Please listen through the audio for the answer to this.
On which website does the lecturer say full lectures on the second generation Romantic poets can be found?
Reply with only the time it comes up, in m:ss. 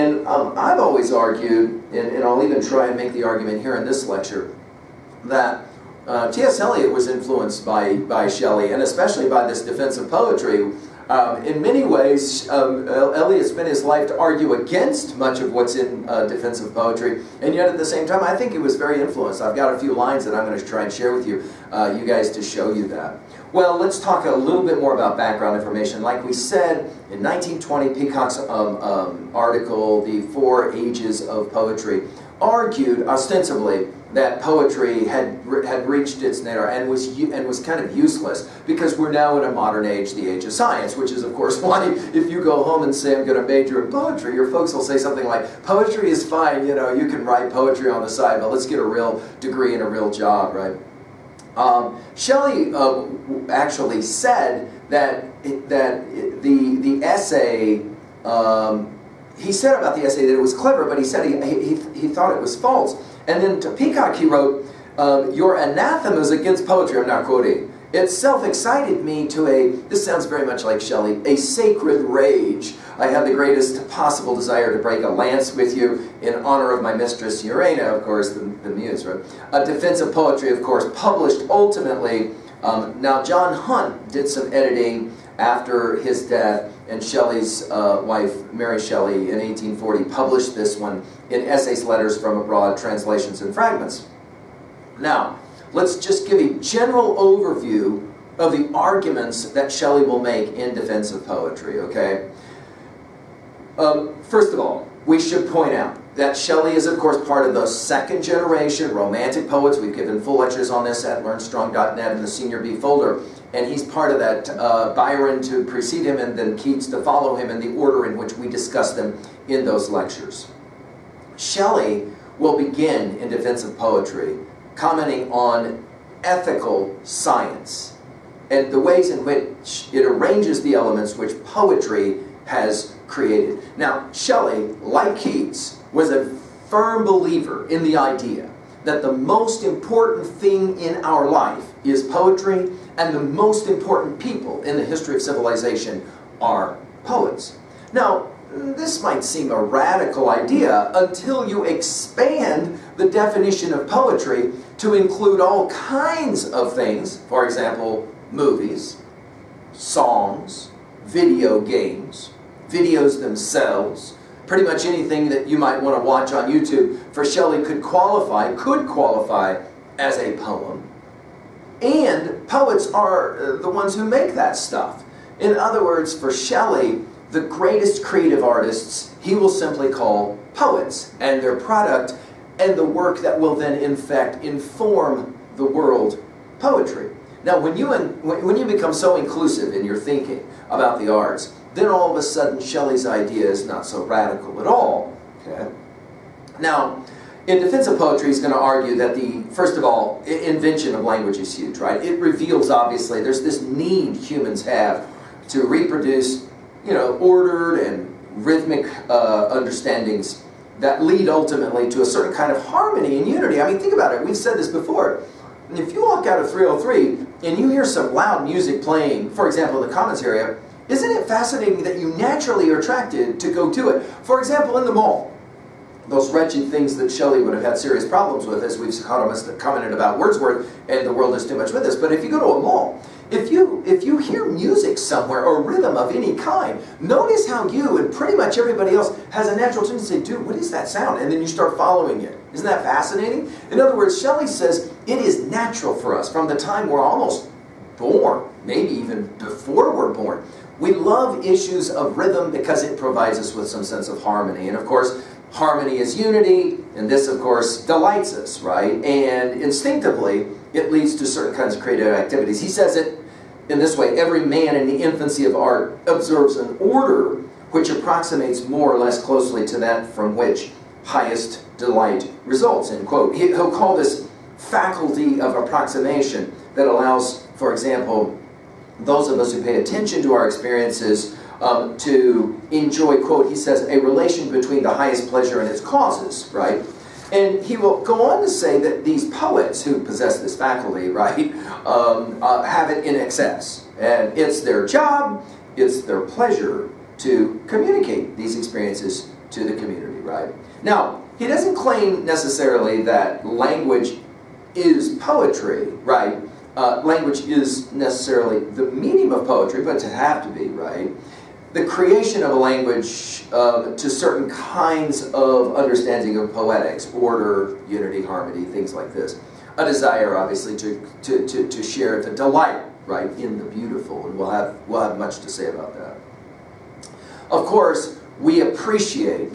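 1:51.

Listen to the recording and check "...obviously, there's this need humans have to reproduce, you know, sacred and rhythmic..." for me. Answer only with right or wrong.
wrong.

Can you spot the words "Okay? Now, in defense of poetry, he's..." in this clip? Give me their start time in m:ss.
3:15.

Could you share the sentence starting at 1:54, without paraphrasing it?
Uh, Byron to precede him, and then Keats to follow him in the order in which we discuss them in those lectures.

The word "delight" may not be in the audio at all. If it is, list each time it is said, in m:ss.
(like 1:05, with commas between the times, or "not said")
4:17, 4:31, 5:22.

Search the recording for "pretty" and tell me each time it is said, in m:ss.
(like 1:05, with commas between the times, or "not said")
2:44, 3:58.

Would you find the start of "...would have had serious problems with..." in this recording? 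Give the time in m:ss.
3:47.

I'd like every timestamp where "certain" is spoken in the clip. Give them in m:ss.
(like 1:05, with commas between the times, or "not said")
3:32, 4:21, 5:14.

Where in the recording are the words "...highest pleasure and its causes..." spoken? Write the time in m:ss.
4:44.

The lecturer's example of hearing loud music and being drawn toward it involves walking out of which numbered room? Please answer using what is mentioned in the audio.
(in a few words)
303.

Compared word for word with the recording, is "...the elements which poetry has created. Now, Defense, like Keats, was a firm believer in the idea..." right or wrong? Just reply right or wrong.
wrong.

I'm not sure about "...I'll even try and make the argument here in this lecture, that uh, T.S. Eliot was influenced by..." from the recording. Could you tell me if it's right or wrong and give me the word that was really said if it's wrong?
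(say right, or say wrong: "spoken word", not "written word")
right.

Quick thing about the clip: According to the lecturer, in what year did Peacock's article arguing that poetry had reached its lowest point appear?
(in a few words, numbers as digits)
1920.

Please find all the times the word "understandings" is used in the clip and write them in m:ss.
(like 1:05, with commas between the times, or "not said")
3:29, 5:15.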